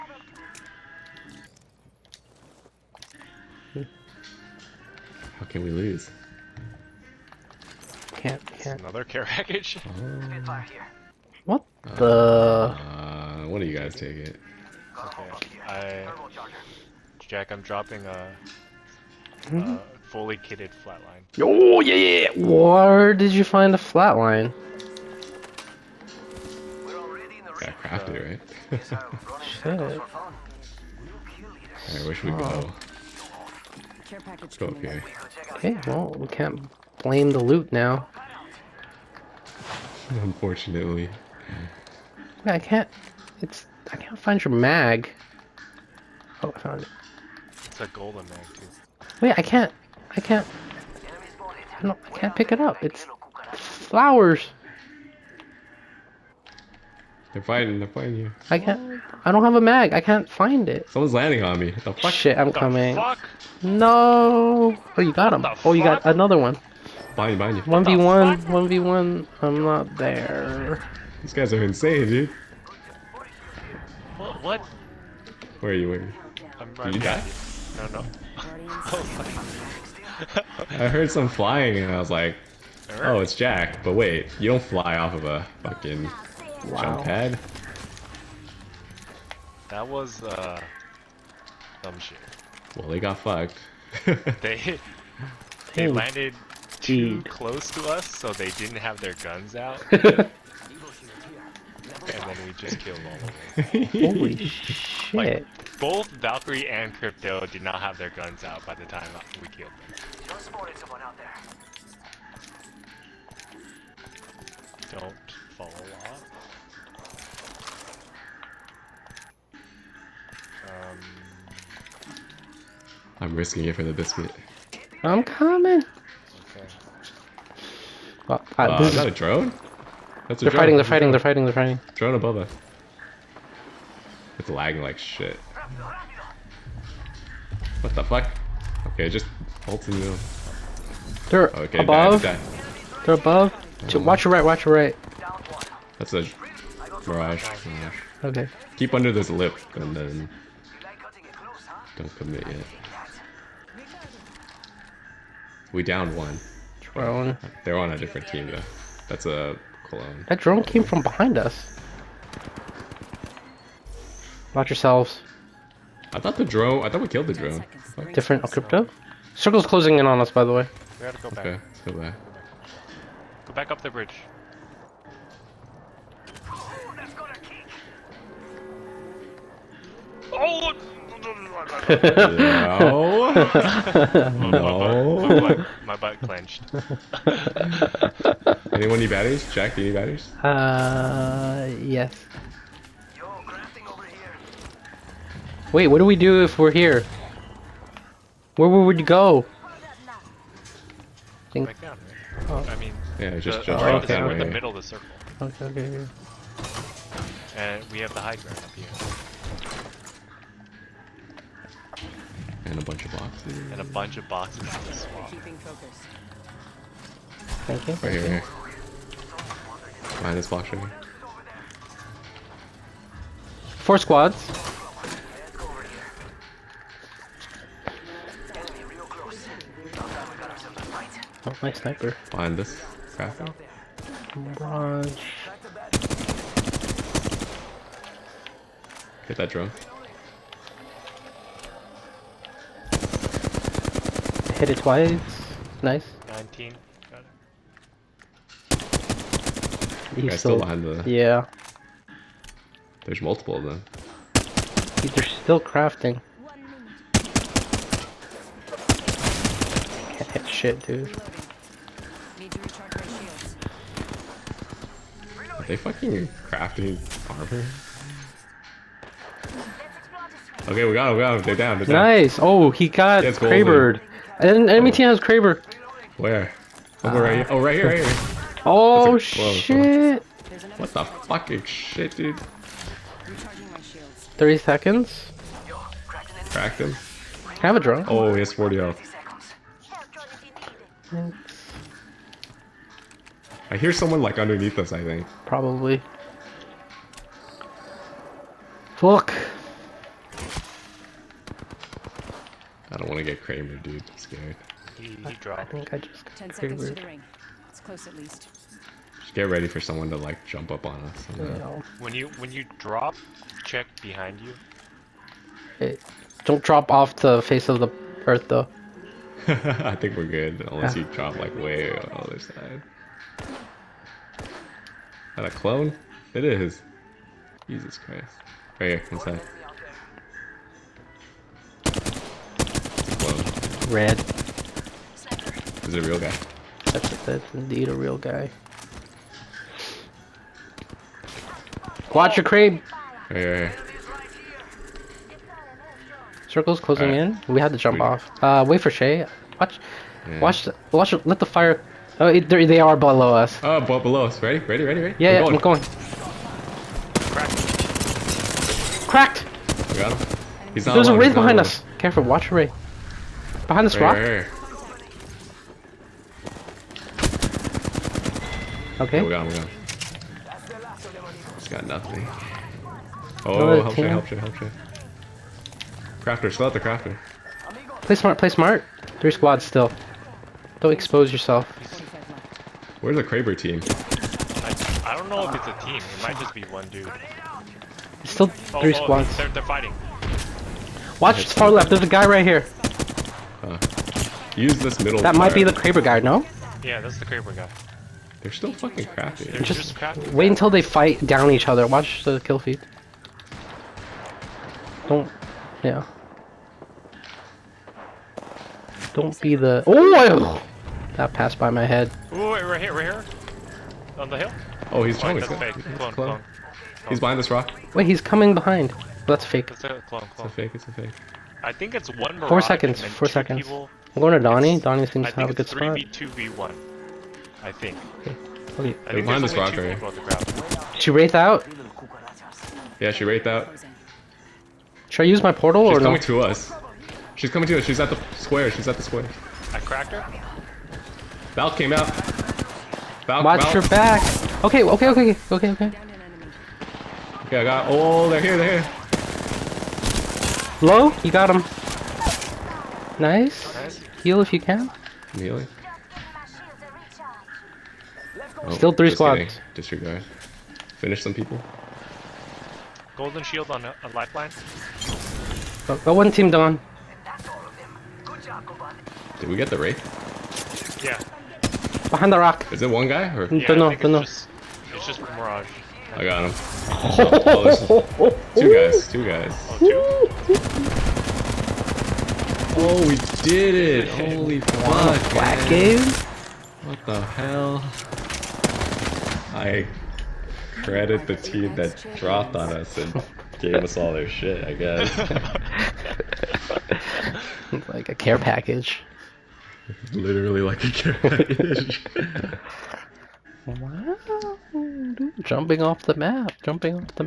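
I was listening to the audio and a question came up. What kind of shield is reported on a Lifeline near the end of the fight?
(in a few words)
Golden shield.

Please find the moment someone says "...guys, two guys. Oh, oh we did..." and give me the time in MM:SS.
07:58.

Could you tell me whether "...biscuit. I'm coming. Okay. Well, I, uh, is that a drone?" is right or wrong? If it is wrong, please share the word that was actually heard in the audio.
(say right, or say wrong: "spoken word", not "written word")
right.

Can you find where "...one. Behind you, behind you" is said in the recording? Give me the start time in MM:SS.
01:06.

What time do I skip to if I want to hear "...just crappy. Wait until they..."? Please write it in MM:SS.
06:39.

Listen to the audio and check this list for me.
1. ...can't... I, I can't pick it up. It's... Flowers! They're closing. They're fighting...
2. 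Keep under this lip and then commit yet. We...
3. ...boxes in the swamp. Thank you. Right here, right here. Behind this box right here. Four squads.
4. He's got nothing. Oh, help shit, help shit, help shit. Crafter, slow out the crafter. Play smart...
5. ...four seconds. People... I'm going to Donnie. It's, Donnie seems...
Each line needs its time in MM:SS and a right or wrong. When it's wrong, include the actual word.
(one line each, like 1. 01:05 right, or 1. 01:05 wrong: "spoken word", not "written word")
1. 00:50 wrong: "fighting", not "closing"
2. 02:28 right
3. 03:34 right
4. 06:11 right
5. 07:03 right.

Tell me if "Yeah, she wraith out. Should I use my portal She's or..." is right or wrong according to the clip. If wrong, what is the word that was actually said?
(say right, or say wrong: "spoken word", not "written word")
right.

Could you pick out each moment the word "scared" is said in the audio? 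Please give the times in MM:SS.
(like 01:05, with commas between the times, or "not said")
05:04.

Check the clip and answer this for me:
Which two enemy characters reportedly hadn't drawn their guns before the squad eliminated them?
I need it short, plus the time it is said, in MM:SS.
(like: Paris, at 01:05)
Valkyrie and Crypto, at 01:46.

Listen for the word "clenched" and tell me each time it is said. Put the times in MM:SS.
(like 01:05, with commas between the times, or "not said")
03:06.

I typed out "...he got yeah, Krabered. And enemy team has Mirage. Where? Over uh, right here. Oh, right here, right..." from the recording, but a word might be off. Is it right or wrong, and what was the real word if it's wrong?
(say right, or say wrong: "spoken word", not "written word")
wrong: "Kraber", not "Mirage".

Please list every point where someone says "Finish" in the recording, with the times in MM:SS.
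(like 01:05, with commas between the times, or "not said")
07:40.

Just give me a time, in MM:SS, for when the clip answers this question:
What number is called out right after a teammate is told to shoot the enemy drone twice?
04:06.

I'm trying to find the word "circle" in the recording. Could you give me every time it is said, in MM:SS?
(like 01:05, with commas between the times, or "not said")
02:49, 03:24, 05:46.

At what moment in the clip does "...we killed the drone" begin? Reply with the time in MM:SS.
02:47.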